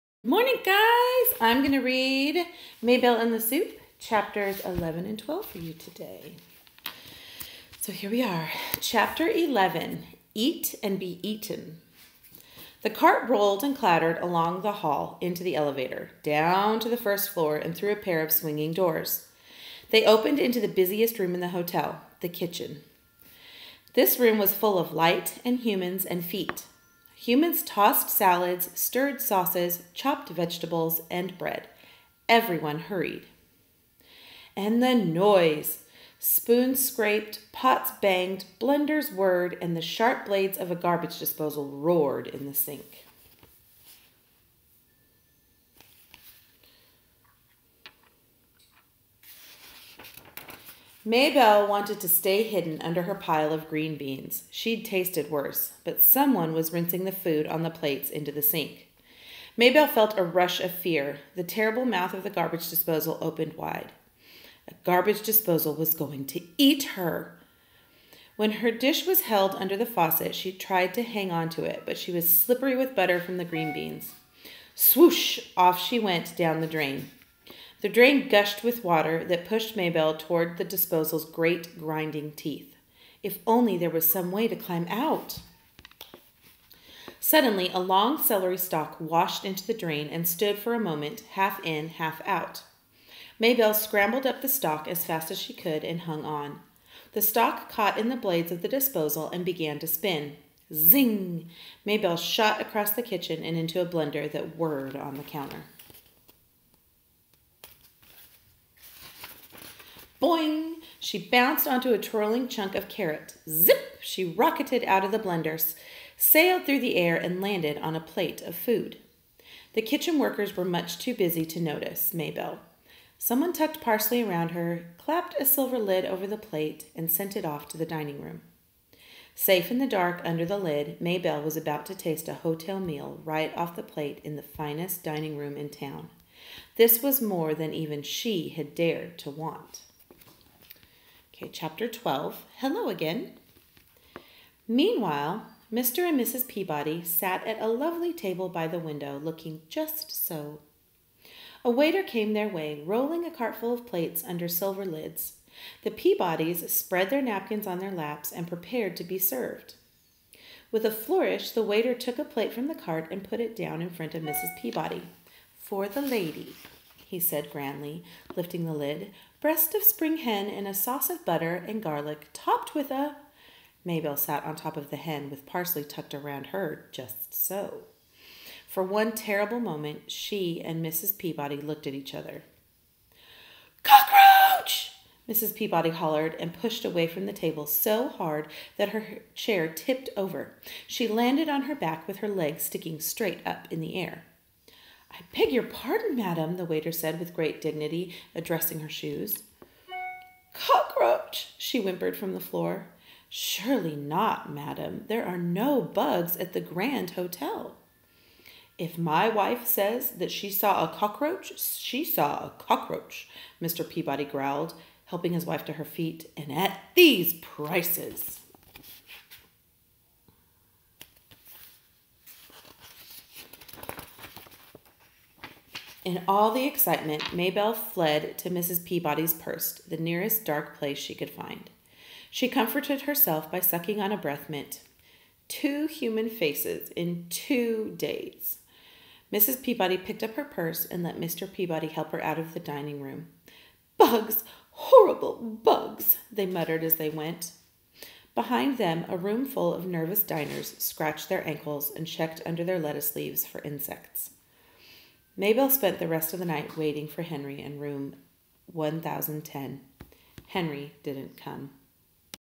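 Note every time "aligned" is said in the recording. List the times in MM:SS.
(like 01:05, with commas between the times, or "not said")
not said.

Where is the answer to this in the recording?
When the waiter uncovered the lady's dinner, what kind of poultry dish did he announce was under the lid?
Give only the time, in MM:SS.
02:49.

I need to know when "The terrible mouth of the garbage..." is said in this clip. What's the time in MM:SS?
01:01.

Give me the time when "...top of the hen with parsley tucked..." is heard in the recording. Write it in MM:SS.
02:54.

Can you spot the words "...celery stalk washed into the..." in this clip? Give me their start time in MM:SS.
01:28.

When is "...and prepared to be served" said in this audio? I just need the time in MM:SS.
02:38.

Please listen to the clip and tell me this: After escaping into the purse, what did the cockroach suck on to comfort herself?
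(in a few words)
A breath mint.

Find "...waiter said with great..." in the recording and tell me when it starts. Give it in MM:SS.
03:16.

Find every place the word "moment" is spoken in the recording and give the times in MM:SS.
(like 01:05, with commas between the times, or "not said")
01:30, 02:59.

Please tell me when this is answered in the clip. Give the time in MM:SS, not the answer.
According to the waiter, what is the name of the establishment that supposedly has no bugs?
03:26.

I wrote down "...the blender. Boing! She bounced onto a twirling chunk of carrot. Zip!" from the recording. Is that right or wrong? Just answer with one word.
wrong.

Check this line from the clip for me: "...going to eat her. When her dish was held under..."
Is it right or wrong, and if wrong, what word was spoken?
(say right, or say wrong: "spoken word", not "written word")
right.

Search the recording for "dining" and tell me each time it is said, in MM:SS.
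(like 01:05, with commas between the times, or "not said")
02:07, 02:15, 04:02.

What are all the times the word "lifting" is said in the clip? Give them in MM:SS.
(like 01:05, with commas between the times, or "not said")
02:48.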